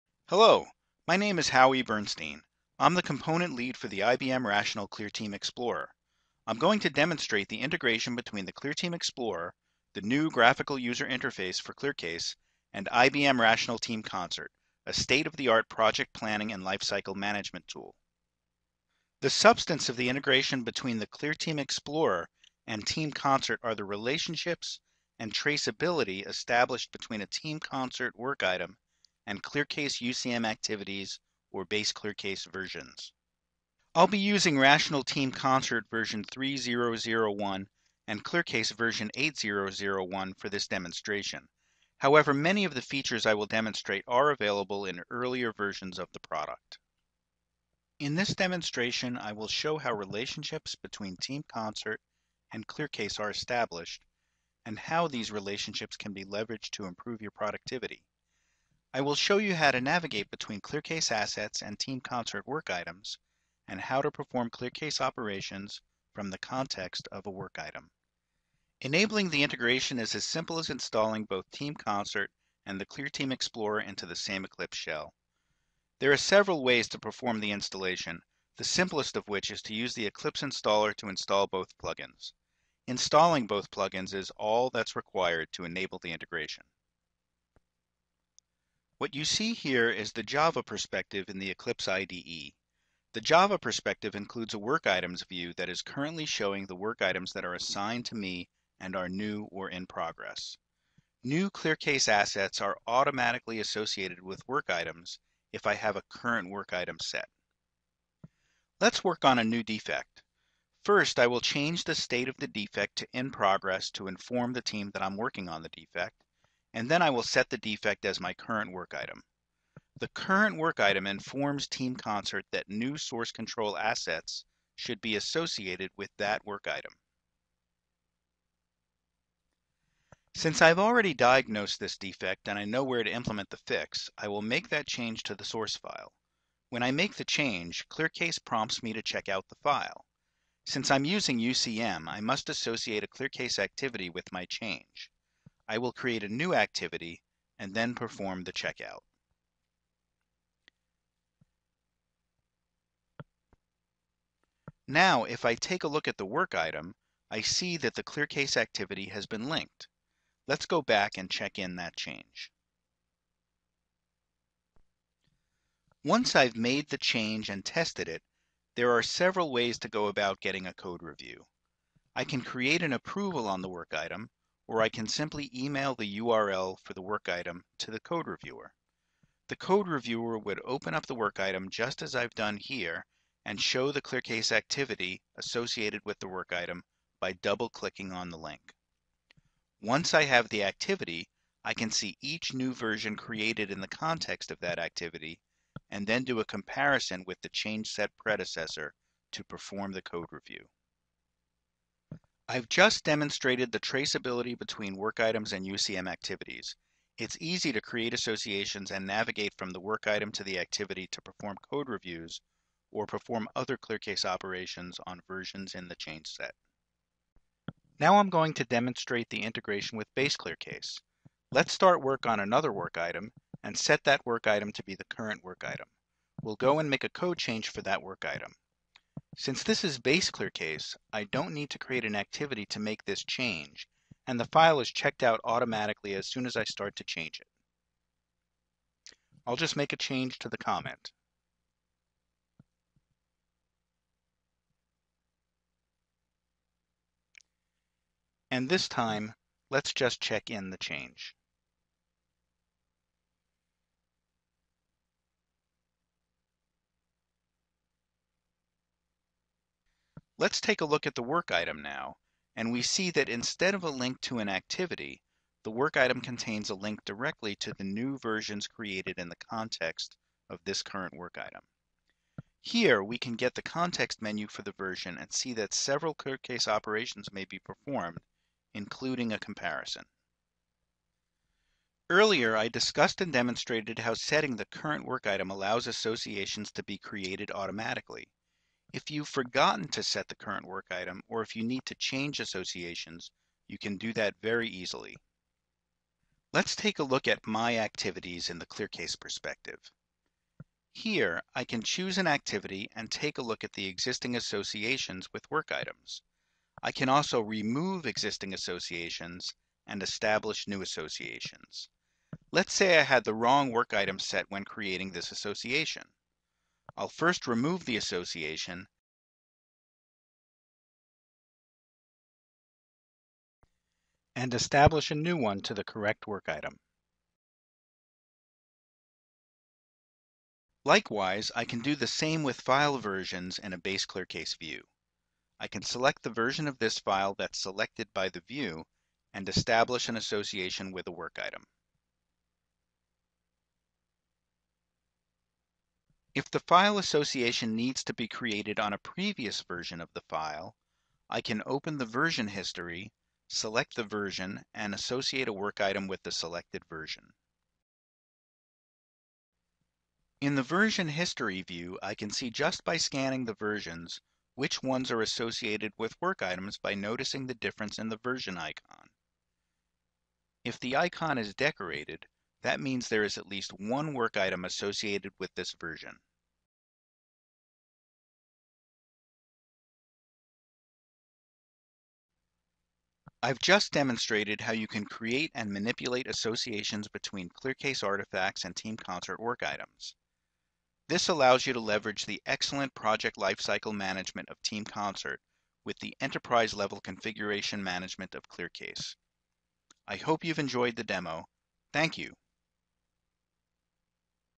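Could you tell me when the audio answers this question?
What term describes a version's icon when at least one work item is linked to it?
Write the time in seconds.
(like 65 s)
371 s.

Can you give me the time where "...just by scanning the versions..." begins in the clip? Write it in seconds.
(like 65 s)
362 s.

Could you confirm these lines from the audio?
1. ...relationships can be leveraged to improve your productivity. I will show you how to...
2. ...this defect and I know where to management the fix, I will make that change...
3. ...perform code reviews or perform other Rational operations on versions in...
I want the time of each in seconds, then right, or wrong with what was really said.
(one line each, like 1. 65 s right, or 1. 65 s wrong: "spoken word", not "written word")
1. 55 s right
2. 131 s wrong: "implement", not "management"
3. 211 s wrong: "ClearCase", not "Rational".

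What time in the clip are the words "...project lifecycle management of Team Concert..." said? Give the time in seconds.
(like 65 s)
392 s.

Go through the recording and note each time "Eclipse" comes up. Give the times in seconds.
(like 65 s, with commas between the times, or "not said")
74 s, 80 s, 91 s.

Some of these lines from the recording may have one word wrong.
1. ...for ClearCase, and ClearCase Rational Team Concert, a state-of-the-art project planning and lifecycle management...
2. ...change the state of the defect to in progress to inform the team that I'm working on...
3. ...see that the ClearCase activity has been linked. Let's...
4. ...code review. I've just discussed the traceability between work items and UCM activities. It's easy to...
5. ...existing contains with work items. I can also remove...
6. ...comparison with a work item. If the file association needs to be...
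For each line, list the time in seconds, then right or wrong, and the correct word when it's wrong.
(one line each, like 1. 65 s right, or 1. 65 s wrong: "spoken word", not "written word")
1. 11 s wrong: "IBM", not "ClearCase"
2. 111 s right
3. 157 s right
4. 200 s wrong: "demonstrated", not "discussed"
5. 303 s wrong: "associations", not "contains"
6. 340 s wrong: "association", not "comparison".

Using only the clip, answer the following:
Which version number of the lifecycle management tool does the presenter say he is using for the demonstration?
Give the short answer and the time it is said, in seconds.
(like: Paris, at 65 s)
3001, at 35 s.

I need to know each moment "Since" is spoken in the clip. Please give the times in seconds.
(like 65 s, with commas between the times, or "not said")
130 s, 140 s, 229 s.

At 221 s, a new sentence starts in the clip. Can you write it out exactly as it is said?
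Let's start work on another work item and set that work item to be the current work item.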